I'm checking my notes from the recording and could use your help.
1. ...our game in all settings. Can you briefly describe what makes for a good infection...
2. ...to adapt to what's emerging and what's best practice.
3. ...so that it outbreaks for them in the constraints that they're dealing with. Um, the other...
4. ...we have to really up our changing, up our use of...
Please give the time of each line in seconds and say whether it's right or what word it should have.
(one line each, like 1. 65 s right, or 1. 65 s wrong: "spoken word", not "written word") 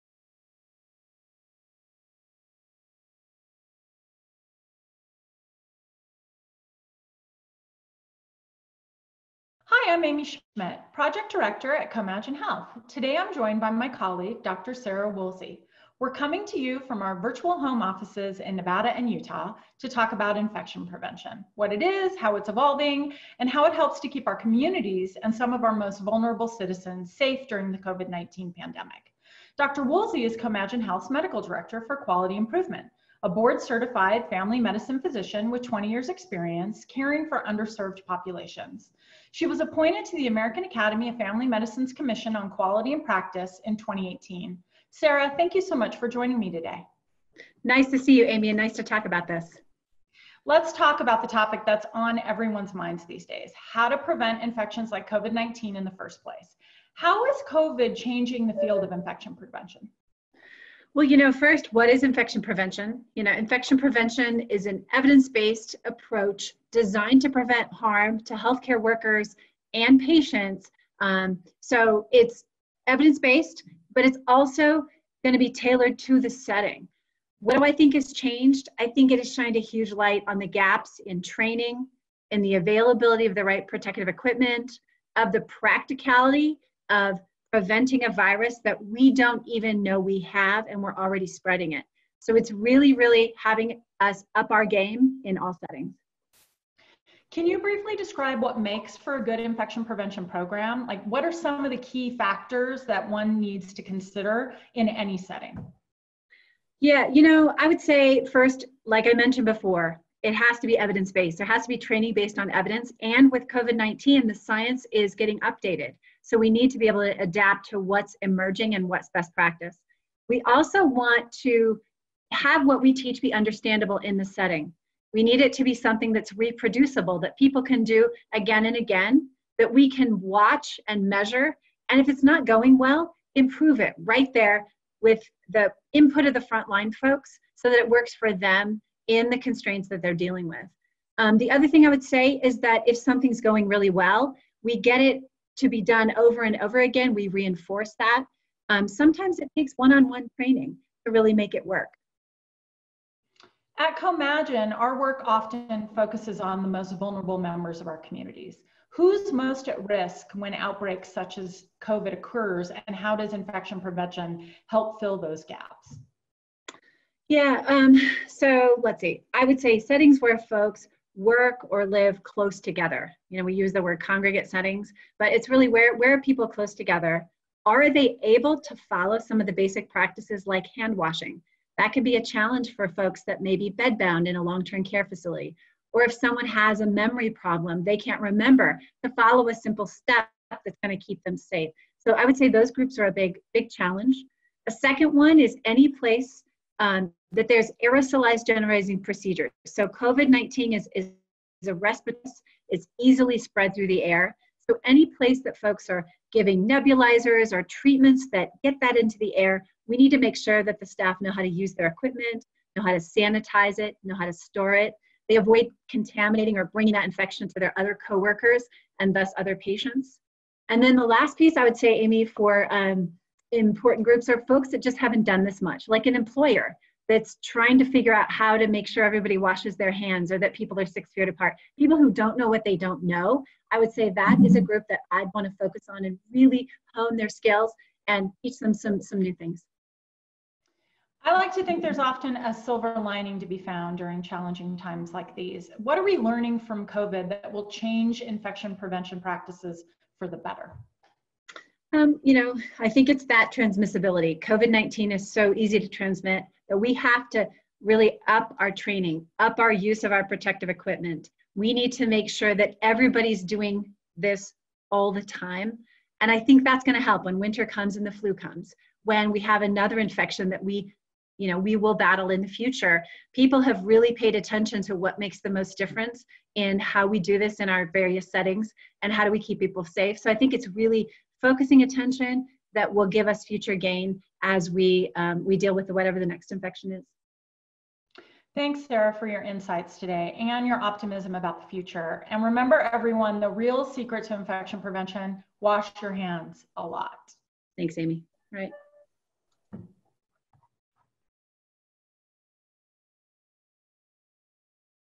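1. 94 s right
2. 117 s right
3. 137 s wrong: "works", not "outbreaks"
4. 256 s wrong: "training", not "changing".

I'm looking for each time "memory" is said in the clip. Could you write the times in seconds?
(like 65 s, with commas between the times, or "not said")
186 s.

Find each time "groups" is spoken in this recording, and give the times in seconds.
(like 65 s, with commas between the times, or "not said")
192 s, 224 s, 234 s.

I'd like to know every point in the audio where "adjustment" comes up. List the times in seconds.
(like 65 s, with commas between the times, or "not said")
not said.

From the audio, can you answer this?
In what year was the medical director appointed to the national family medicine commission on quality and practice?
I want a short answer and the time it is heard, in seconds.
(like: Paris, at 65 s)
2018, at 43 s.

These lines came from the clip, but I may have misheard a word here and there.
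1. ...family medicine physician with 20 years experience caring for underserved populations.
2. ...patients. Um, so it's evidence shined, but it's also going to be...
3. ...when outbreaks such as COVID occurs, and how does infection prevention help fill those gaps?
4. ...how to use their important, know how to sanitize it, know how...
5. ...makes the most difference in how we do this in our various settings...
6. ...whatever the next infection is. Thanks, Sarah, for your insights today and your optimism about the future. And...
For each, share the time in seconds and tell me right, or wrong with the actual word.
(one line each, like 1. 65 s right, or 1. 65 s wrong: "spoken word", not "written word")
1. 34 s right
2. 70 s wrong: "based", not "shined"
3. 160 s right
4. 211 s wrong: "equipment", not "important"
5. 275 s right
6. 285 s right.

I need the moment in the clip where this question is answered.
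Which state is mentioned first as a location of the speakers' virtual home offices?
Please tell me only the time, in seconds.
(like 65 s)
18 s.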